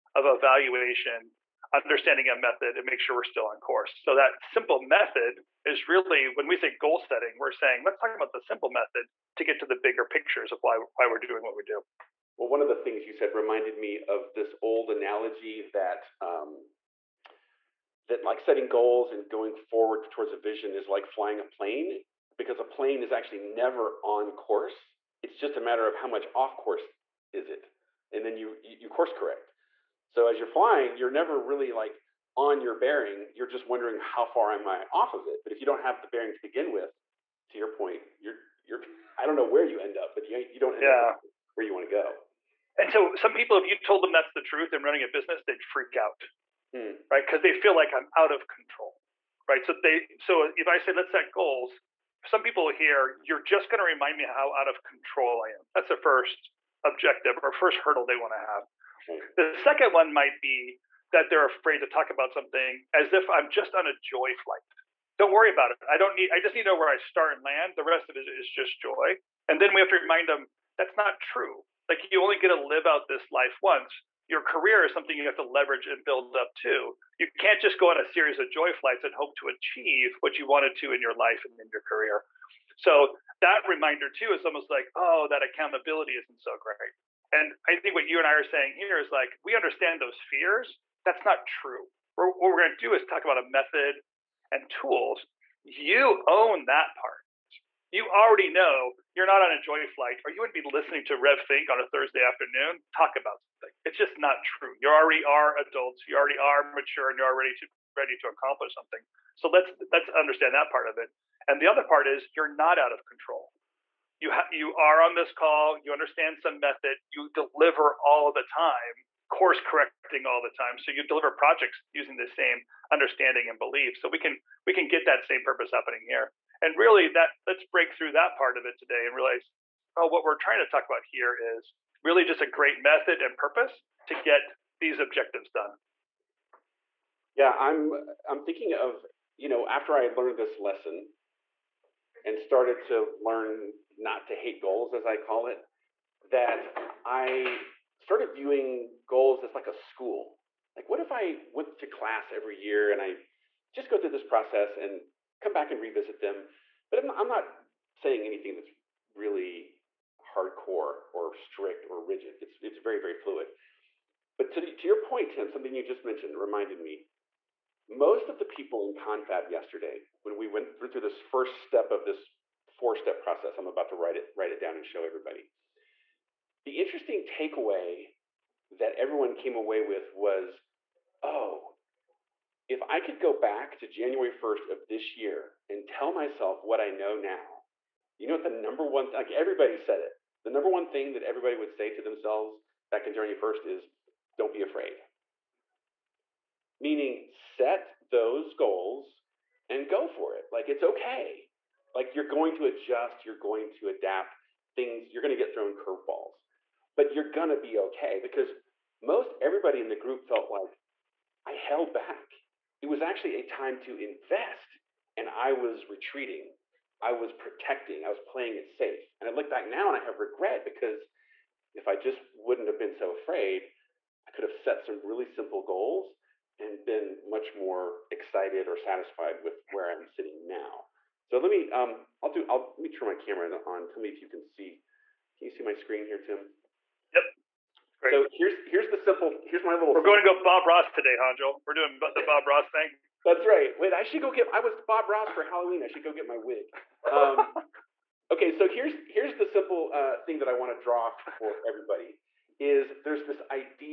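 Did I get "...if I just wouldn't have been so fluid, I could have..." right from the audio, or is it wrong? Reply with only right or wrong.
wrong.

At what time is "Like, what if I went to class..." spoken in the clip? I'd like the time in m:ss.
2:30.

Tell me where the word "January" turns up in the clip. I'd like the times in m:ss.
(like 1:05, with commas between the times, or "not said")
3:03, 3:13.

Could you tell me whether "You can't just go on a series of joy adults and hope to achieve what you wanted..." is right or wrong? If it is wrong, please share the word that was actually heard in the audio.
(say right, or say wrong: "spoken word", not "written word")
wrong: "flights", not "adults".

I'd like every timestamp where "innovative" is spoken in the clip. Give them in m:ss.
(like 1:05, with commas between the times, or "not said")
not said.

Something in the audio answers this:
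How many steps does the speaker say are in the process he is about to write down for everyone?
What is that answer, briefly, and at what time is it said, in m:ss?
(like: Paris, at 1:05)
4, at 2:52.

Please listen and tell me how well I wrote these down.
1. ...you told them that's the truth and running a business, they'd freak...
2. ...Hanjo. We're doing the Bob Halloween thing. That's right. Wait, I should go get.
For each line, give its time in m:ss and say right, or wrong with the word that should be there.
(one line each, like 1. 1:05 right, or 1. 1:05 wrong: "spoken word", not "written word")
1. 0:43 right
2. 4:01 wrong: "Ross", not "Halloween".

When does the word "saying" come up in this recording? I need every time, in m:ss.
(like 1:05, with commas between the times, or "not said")
0:07, 1:28, 2:37.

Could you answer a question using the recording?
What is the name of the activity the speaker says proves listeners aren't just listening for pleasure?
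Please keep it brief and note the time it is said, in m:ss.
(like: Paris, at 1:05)
RevThink, at 1:41.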